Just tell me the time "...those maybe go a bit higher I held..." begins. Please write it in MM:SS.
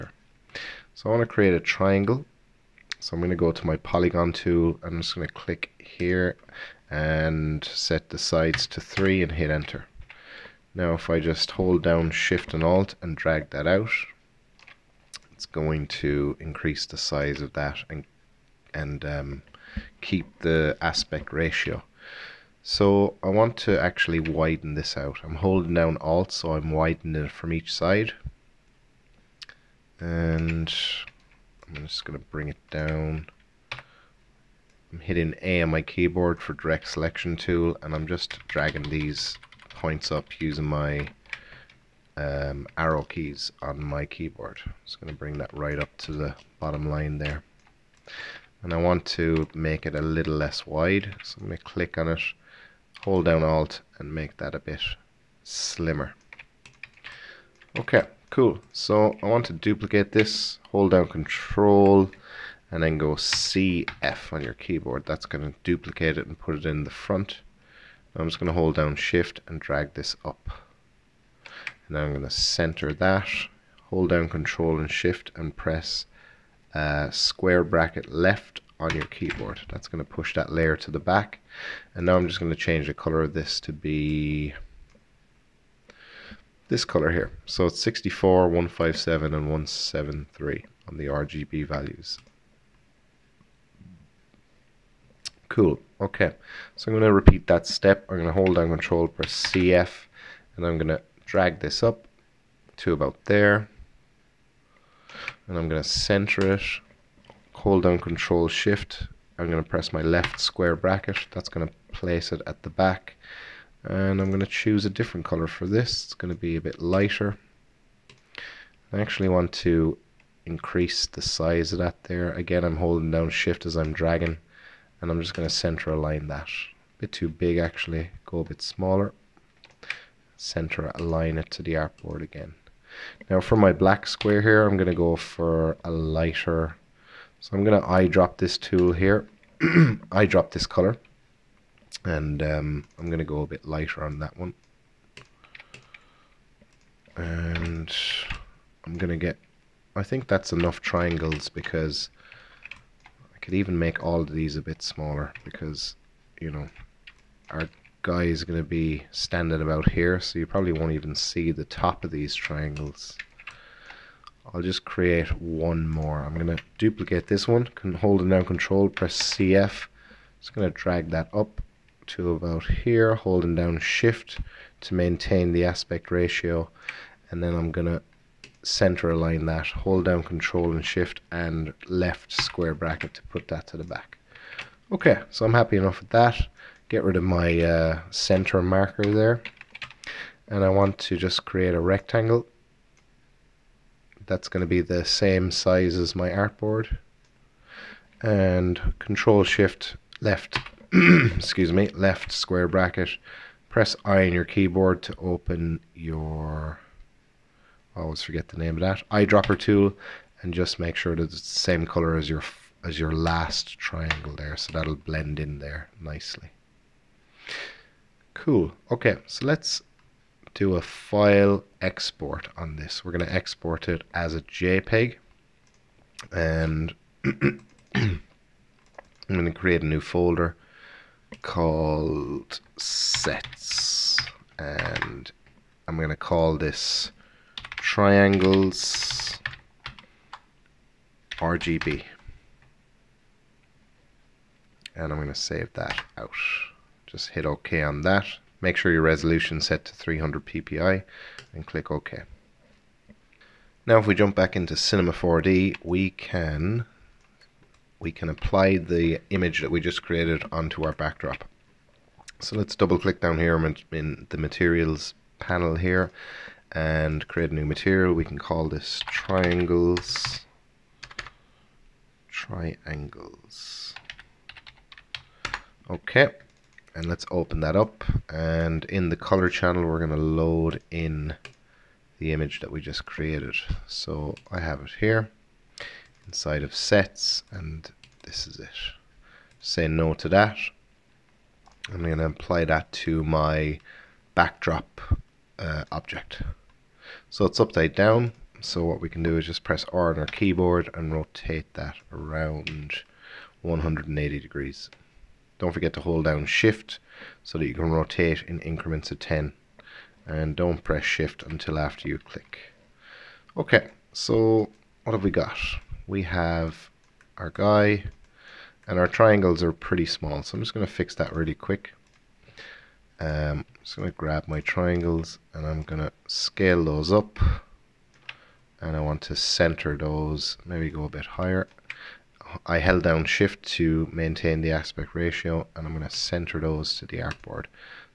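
05:29.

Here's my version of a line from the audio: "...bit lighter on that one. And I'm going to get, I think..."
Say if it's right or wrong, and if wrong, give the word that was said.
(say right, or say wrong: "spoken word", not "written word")
right.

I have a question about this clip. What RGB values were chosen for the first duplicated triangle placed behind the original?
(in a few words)
64, 157, 173.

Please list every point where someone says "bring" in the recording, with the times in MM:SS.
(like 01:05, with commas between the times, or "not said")
00:32, 00:45.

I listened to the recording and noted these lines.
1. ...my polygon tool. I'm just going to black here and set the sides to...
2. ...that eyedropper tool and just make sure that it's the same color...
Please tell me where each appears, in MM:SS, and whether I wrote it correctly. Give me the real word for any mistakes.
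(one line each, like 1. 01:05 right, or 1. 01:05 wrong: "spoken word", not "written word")
1. 00:03 wrong: "click", not "black"
2. 03:28 right.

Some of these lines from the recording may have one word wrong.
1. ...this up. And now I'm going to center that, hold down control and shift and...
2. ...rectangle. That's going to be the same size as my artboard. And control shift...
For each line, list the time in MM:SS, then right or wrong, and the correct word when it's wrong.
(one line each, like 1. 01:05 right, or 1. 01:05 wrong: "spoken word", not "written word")
1. 01:09 right
2. 03:11 right.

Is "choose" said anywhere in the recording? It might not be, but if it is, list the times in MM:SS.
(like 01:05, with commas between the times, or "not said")
01:54.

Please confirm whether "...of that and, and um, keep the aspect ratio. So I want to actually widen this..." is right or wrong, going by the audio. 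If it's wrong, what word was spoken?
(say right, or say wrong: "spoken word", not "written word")
right.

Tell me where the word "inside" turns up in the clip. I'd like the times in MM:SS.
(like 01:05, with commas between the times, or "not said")
04:46.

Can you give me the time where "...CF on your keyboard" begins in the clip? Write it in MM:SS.
01:03.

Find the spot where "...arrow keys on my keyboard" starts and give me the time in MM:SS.
00:42.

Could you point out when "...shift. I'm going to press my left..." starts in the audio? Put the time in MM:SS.
01:48.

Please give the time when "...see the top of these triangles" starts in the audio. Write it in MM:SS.
02:41.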